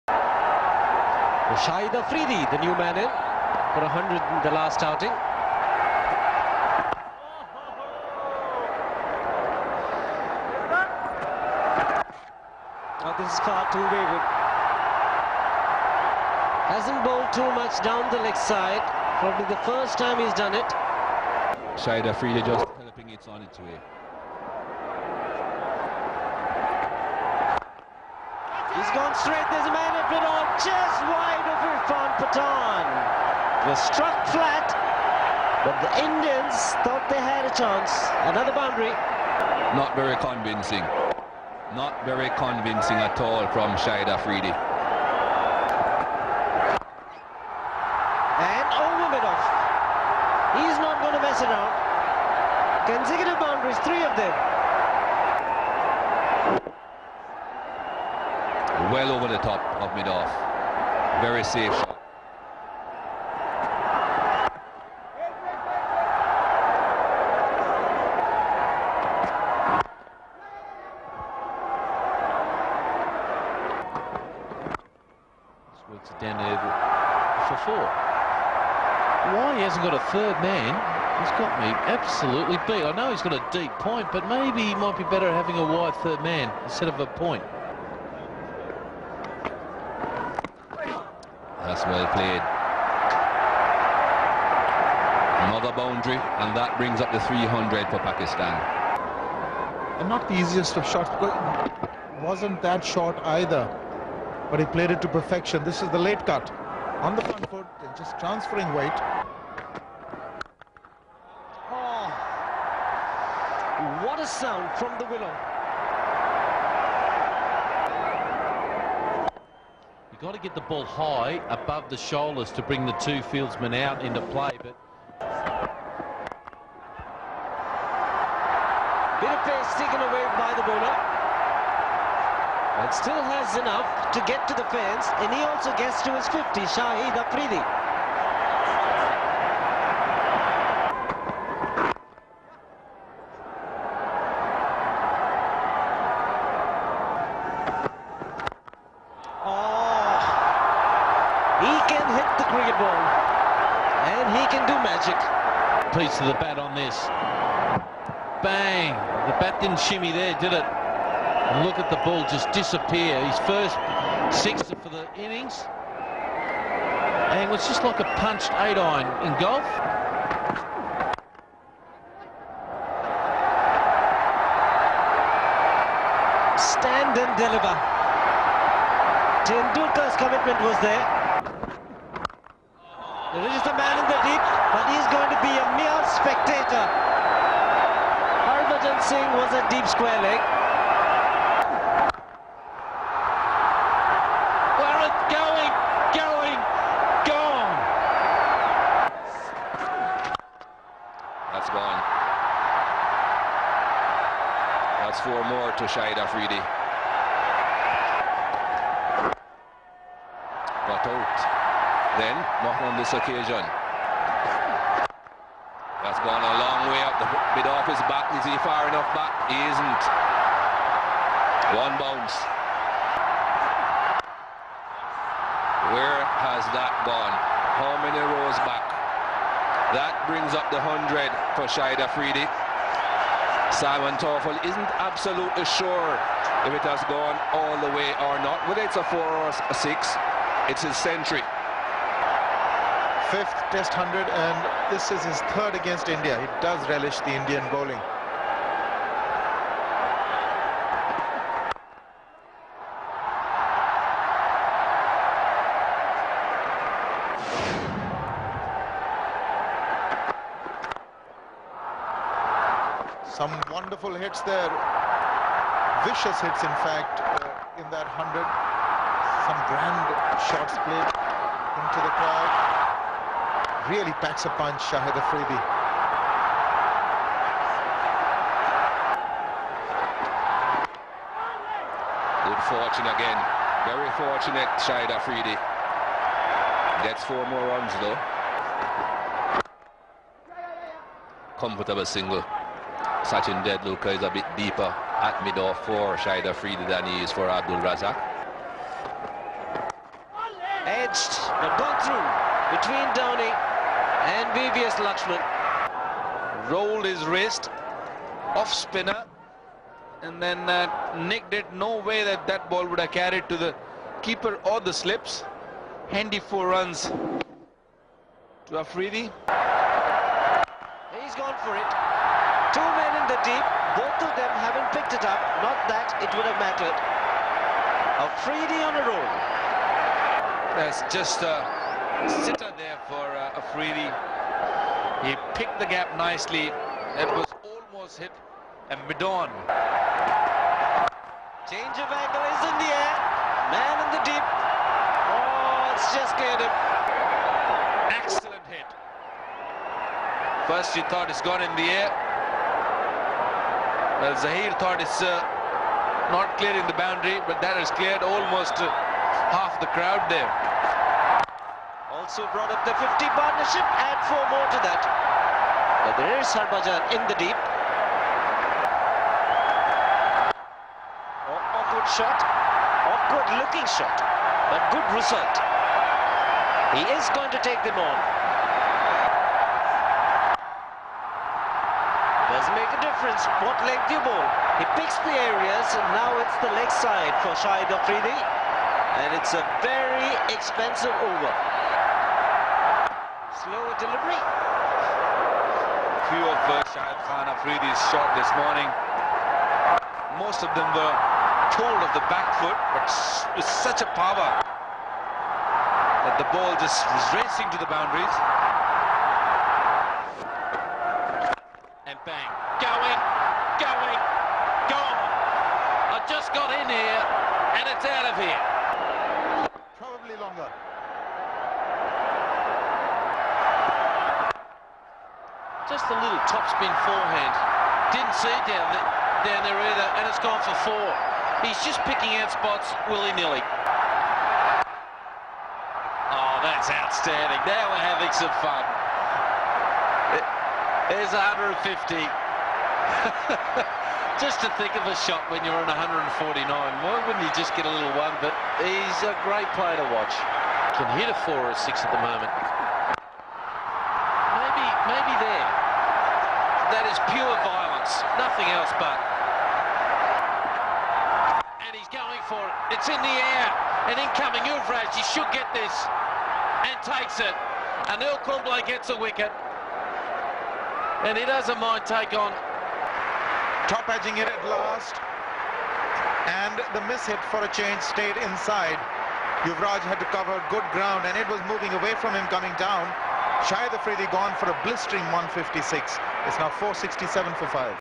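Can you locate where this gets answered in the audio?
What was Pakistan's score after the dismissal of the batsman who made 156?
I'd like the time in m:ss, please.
8:06.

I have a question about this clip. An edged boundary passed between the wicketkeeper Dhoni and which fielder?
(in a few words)
VVS Laxman.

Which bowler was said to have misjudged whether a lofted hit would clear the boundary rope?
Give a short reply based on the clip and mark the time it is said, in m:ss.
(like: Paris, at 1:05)
Zaheer, at 5:54.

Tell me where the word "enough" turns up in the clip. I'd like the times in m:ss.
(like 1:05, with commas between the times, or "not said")
2:13, 3:38.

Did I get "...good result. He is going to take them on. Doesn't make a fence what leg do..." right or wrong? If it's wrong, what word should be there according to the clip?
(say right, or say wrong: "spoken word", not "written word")
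wrong: "difference", not "fence".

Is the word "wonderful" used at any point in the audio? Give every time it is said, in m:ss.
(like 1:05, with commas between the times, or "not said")
4:23.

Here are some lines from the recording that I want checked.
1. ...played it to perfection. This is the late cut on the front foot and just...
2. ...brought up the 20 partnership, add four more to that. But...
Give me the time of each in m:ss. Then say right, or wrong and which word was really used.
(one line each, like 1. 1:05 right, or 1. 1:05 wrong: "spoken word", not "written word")
1. 1:44 right
2. 6:02 wrong: "50", not "20".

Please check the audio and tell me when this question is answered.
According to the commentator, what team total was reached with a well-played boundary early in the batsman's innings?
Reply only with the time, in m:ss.
1:37.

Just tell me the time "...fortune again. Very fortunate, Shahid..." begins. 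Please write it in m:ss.
4:42.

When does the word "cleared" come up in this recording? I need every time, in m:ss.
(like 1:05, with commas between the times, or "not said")
5:46, 5:57.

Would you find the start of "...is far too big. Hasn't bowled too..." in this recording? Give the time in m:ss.
0:13.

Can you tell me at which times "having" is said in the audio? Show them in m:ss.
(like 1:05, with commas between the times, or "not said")
1:25, 7:18.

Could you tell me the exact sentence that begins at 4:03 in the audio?
Fifth test hundred, and this is his third against India.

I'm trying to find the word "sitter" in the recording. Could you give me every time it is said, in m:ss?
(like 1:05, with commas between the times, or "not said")
5:32.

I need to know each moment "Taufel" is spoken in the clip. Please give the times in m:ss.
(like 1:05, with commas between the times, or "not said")
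3:54.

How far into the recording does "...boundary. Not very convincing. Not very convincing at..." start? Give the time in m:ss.
0:38.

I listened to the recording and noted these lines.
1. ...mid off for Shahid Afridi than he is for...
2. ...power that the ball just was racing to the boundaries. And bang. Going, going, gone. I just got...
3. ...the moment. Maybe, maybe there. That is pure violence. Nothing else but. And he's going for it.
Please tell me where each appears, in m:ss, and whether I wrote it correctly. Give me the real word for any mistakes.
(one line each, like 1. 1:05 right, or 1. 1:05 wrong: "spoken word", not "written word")
1. 4:55 right
2. 6:44 right
3. 7:32 right.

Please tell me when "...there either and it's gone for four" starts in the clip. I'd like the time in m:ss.
7:09.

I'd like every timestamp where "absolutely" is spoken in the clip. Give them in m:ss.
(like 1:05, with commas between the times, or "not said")
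1:21, 3:54.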